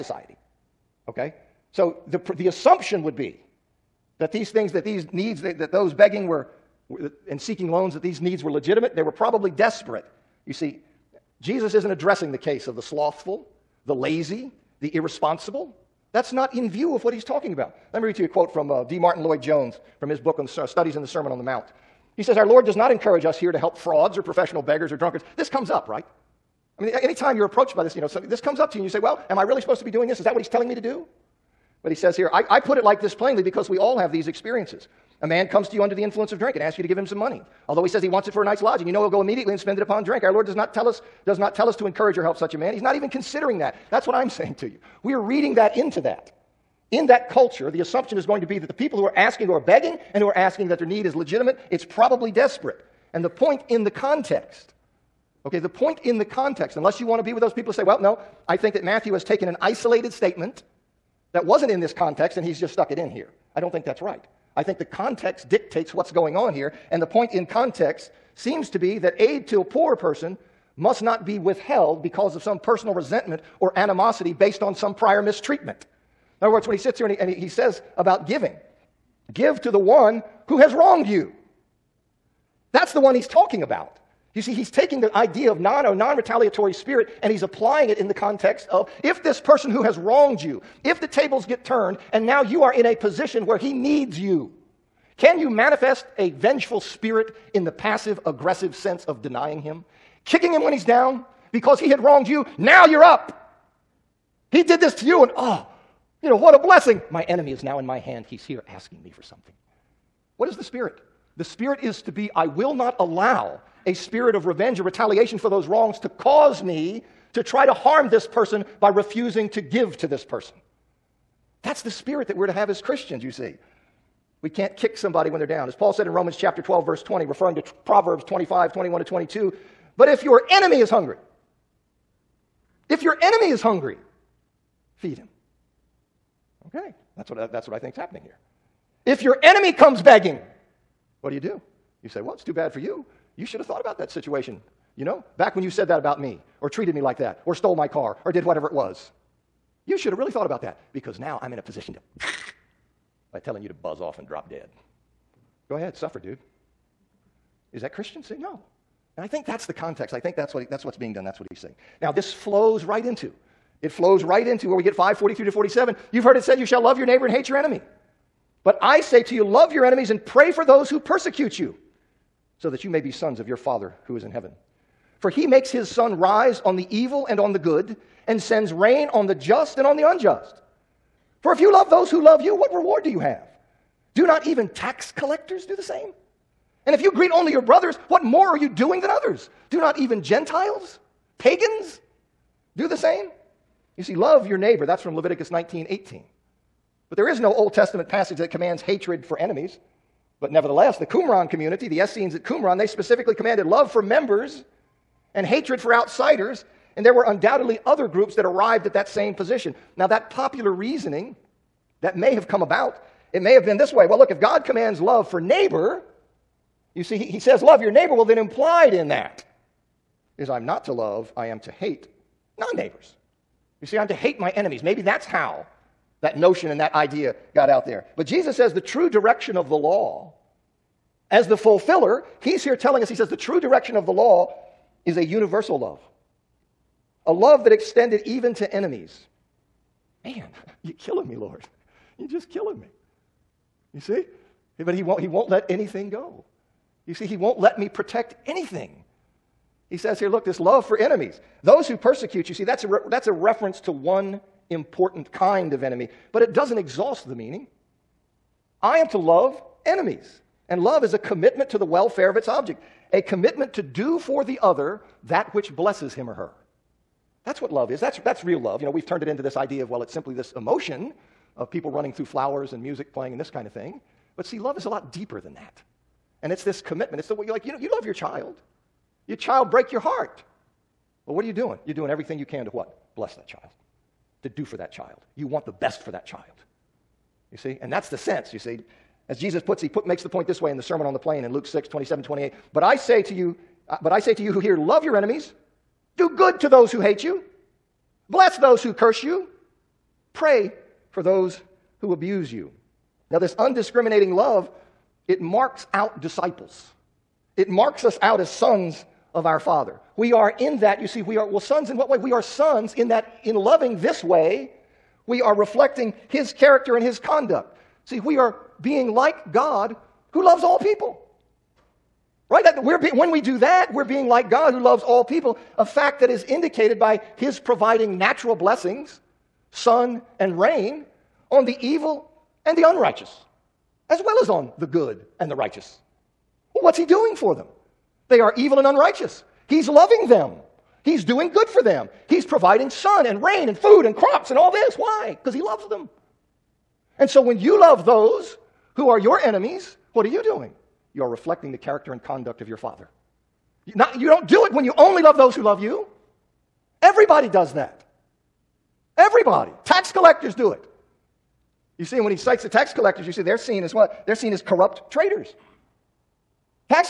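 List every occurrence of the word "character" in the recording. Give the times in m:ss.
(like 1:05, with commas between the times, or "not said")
5:16, 5:51.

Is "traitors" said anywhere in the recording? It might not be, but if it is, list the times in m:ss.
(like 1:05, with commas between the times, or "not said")
6:05.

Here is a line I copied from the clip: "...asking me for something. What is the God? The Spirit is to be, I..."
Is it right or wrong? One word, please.
wrong.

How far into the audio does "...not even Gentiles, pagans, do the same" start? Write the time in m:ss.
3:09.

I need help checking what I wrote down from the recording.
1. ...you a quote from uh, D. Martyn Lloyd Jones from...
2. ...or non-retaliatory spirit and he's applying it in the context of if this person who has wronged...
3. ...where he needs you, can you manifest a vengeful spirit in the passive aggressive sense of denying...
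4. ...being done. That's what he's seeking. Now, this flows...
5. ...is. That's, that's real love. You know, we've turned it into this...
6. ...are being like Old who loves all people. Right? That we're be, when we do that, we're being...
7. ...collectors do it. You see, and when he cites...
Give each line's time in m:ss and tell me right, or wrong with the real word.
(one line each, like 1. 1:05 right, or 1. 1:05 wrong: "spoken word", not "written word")
1. 0:18 right
2. 1:25 right
3. 1:33 right
4. 2:40 wrong: "saying", not "seeking"
5. 4:27 right
6. 5:18 wrong: "God", not "Old"
7. 6:00 right.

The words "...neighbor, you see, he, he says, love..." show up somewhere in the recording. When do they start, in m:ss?
3:35.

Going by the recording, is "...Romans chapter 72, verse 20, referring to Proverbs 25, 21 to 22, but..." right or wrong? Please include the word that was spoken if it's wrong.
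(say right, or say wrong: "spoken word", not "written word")
wrong: "12", not "72".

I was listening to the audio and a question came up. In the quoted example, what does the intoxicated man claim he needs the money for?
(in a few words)
a night's lodging.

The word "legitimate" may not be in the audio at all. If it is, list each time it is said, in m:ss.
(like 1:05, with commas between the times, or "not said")
0:08, 0:51.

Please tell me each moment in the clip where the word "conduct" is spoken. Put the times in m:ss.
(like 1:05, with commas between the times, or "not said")
5:17, 5:52.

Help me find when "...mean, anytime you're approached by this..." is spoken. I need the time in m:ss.
0:26.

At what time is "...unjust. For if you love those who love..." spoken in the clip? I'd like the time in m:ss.
3:00.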